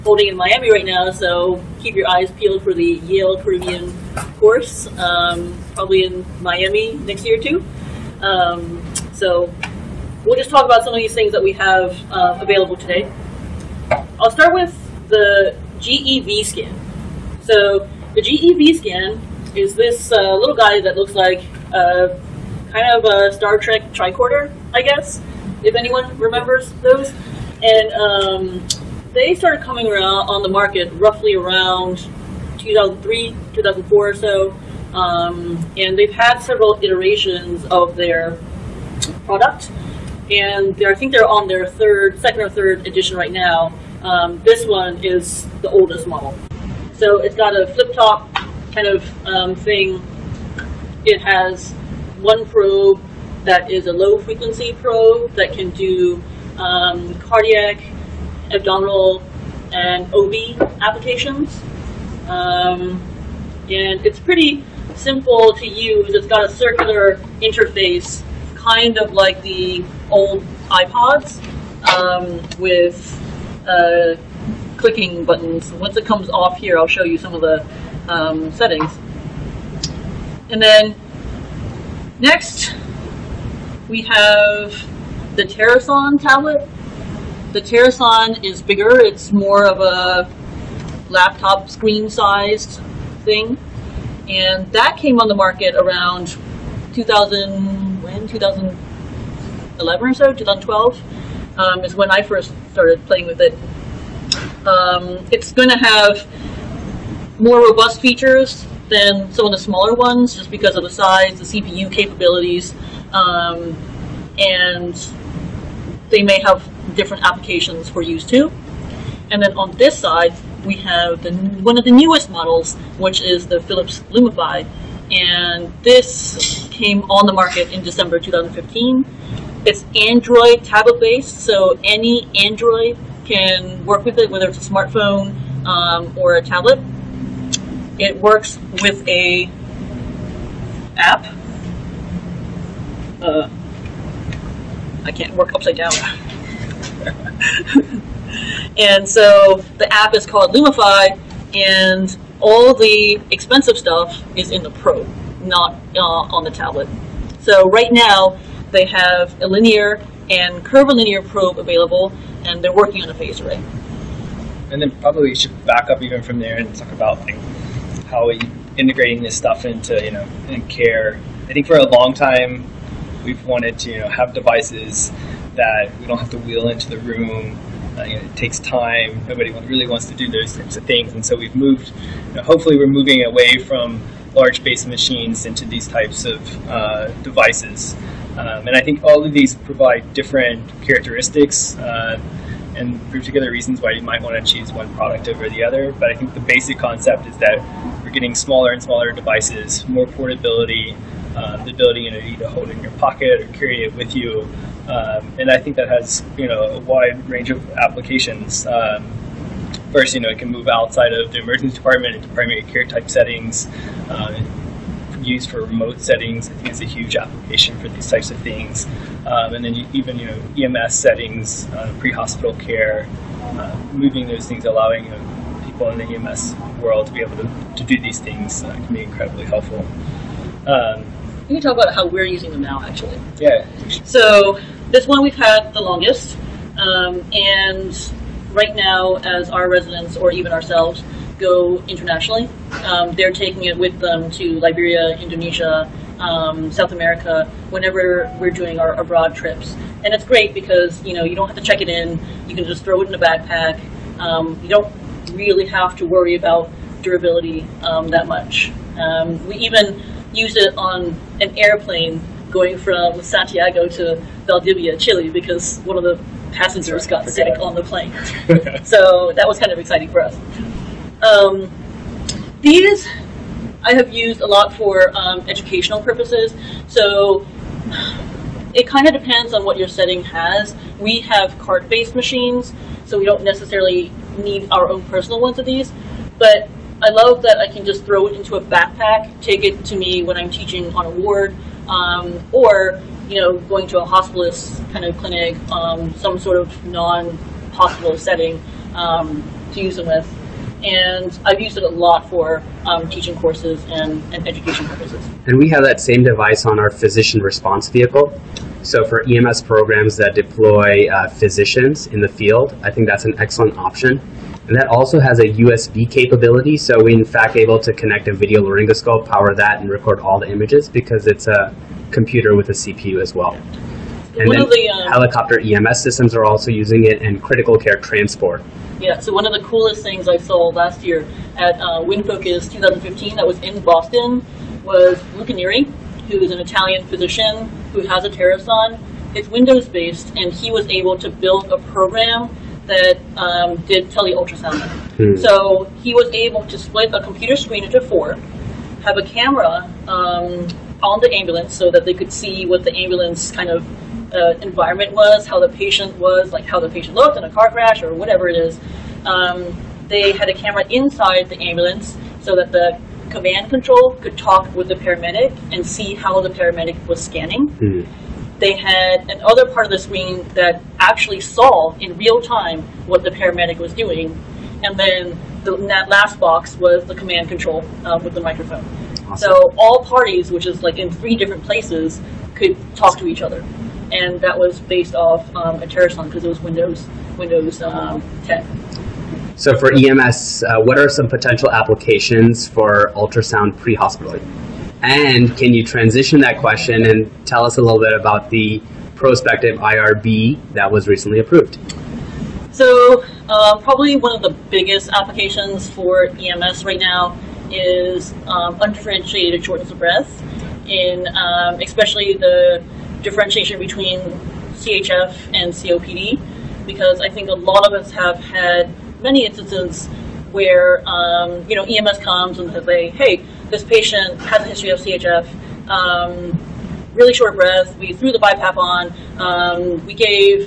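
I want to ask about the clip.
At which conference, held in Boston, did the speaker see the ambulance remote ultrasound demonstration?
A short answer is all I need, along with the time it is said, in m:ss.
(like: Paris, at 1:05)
WINFOCUS 2015, at 5:32.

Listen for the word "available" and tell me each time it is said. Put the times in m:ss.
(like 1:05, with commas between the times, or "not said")
0:12, 2:41.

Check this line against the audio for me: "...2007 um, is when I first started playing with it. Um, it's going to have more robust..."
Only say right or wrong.
wrong.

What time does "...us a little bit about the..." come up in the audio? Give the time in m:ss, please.
6:37.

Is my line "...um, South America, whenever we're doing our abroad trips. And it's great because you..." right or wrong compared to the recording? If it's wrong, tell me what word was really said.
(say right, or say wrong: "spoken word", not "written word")
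right.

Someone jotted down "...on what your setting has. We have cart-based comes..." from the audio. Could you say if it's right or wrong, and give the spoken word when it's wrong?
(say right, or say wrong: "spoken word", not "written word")
wrong: "machines", not "comes".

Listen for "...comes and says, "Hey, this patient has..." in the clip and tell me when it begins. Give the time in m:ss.
7:02.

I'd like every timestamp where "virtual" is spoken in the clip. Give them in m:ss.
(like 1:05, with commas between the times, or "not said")
not said.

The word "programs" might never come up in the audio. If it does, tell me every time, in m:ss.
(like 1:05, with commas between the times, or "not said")
5:09, 5:41.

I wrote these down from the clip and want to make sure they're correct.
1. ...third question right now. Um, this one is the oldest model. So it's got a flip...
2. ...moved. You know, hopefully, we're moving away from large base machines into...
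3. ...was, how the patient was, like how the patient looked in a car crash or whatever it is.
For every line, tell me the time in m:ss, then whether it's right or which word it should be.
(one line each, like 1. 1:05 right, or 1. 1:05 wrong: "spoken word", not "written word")
1. 0:42 wrong: "edition", not "question"
2. 3:01 right
3. 5:55 right.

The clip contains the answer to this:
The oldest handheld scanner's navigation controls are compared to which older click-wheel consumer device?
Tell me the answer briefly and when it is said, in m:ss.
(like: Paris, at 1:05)
iPods, at 1:10.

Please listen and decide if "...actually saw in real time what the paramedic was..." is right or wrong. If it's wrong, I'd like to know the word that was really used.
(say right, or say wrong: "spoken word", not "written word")
right.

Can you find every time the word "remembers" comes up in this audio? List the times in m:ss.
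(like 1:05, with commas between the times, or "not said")
0:26.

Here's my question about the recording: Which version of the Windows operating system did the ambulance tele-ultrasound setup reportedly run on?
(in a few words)
Windows 10.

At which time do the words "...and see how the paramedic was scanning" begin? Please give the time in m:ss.
6:05.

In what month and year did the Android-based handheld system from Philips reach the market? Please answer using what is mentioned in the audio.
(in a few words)
December 2015.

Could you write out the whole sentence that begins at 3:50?
Um, you talk about how we're using them now, actually.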